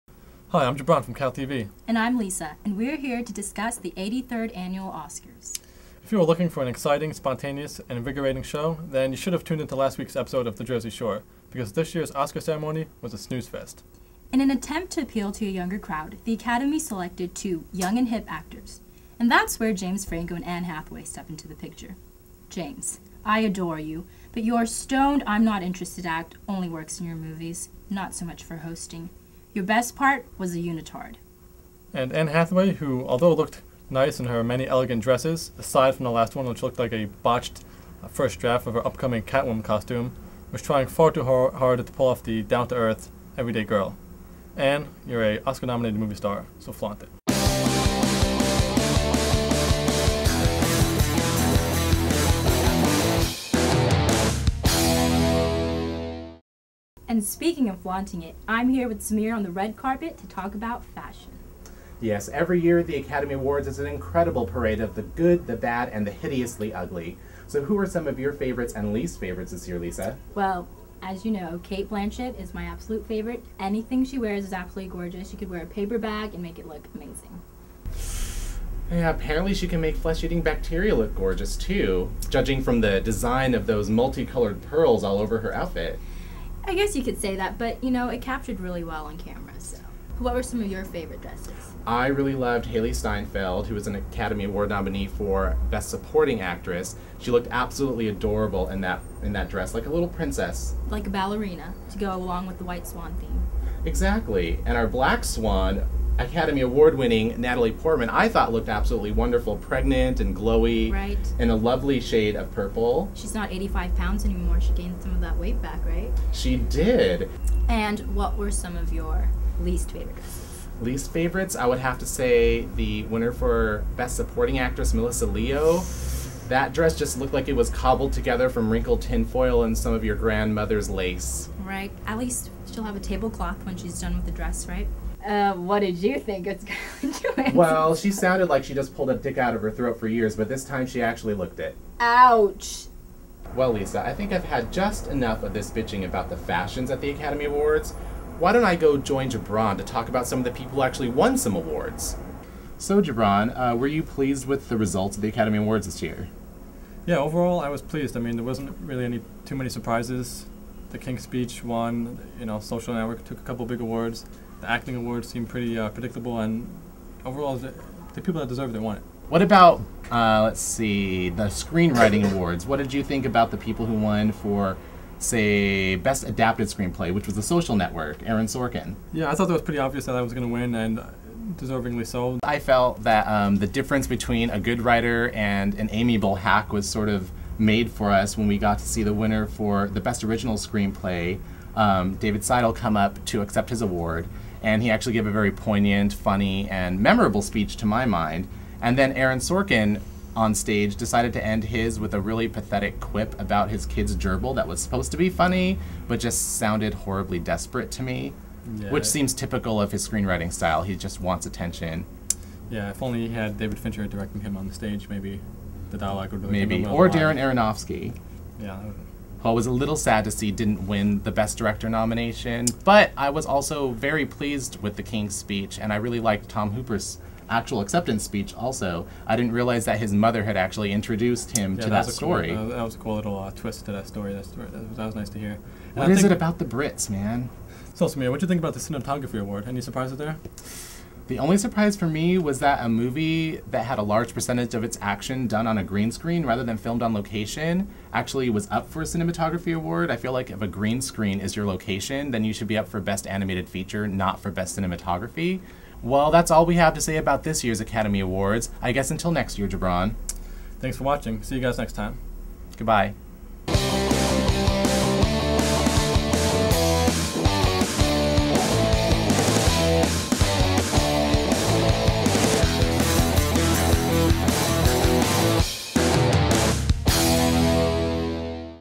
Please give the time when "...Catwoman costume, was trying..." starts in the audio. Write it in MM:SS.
00:39.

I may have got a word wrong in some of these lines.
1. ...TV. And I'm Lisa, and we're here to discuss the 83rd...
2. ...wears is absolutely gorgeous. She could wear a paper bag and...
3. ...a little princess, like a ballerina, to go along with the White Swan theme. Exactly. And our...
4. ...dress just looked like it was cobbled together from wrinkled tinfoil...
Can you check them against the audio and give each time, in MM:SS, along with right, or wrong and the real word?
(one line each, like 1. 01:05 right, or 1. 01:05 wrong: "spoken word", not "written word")
1. 00:01 right
2. 01:14 right
3. 01:39 right
4. 02:06 right.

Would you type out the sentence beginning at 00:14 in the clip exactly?
In an attempt to appeal to a younger crowd, the Academy selected two young and hip actors.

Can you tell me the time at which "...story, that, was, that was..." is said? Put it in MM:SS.
03:54.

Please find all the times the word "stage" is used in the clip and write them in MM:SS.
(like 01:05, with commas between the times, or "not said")
03:20, 03:34.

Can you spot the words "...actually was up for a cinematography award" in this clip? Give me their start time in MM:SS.
04:08.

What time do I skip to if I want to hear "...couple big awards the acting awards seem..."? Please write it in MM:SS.
02:43.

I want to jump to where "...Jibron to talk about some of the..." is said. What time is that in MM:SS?
02:29.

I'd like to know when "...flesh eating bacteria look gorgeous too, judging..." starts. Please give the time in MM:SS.
01:19.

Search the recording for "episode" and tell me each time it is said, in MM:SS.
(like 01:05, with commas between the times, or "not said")
00:10.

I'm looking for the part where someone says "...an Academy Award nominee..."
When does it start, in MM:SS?
01:33.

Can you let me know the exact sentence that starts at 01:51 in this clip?
and a lovely shade of purple.